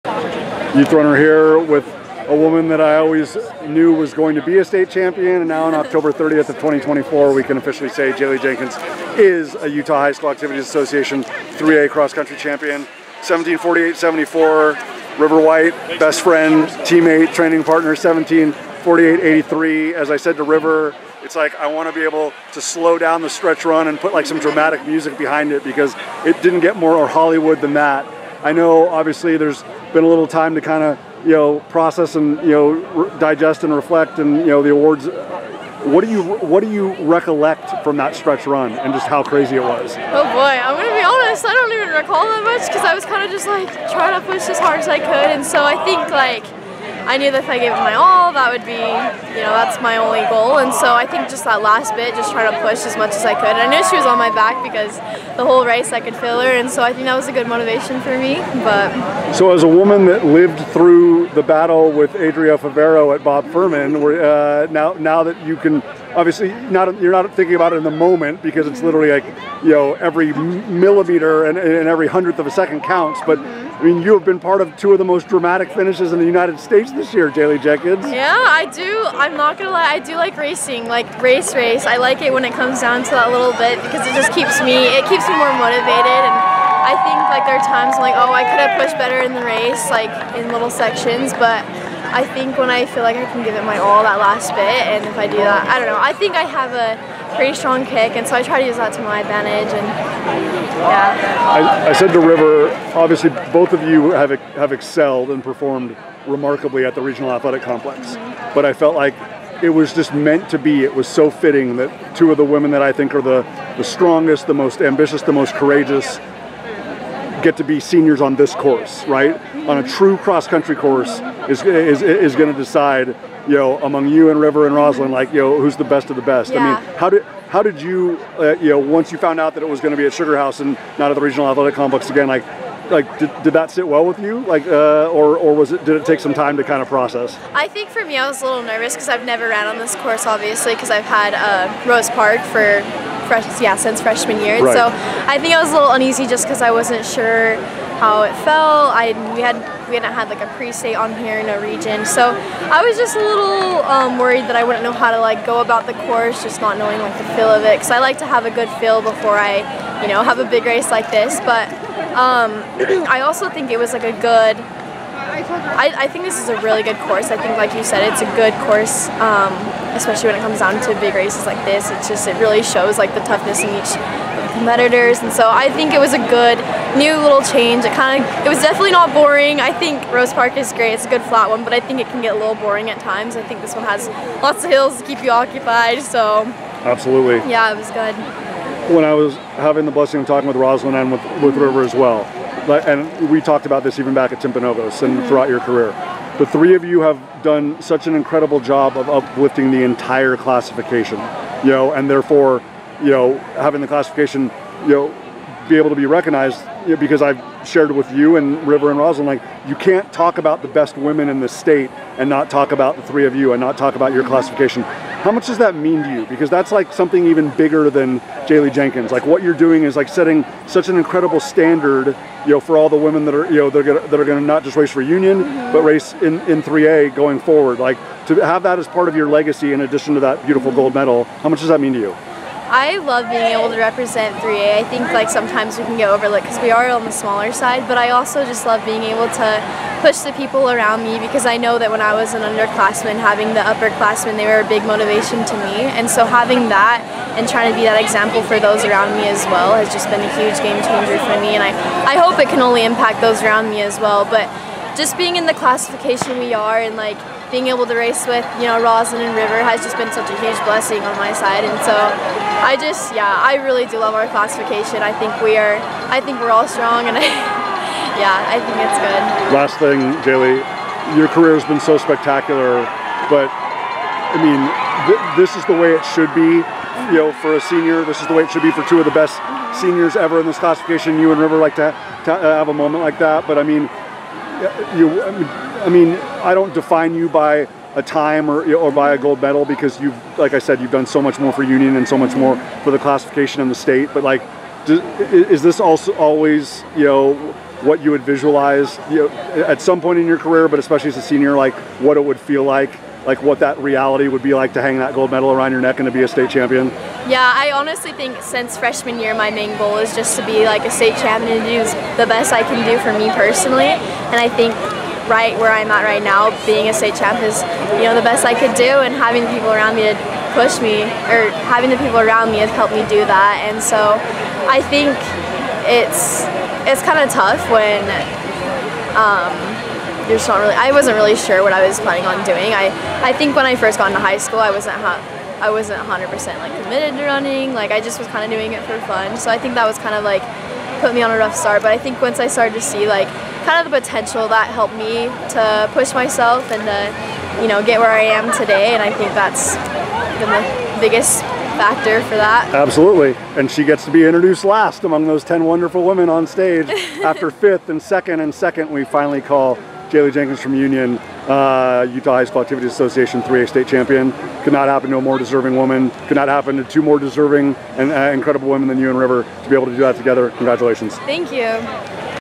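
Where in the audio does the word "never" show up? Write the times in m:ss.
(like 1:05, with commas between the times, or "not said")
2:19.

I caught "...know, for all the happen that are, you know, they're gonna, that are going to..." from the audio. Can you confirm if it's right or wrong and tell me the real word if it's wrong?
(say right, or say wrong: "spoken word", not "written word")
wrong: "women", not "happen".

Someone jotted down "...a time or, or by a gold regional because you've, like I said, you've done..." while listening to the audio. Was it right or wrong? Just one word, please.
wrong.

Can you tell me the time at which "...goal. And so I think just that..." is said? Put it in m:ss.
0:50.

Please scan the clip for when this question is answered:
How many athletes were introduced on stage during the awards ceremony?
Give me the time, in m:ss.
5:55.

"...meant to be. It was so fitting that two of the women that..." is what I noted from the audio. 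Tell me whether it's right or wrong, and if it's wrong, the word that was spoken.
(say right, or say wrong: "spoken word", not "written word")
right.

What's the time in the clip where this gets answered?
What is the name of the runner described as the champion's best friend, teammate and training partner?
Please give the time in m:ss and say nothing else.
0:15.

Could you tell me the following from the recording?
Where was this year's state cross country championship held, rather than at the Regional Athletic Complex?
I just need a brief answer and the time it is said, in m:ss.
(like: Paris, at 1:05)
Sugar House, at 2:10.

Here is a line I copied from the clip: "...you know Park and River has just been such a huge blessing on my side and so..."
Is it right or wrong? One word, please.
wrong.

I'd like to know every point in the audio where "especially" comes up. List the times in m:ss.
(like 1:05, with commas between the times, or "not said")
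2:49, 5:00.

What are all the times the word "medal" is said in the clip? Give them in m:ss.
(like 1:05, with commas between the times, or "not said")
3:50, 4:49, 5:05.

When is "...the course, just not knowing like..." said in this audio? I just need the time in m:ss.
2:35.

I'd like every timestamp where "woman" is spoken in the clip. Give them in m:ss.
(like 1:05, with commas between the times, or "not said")
0:02, 0:59, 6:05.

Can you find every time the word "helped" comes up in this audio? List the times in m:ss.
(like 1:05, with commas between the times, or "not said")
5:22, 5:44.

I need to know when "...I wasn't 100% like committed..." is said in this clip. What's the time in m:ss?
5:34.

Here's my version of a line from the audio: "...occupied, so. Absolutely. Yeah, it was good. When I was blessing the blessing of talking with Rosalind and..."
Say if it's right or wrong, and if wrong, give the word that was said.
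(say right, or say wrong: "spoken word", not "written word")
wrong: "having", not "blessing".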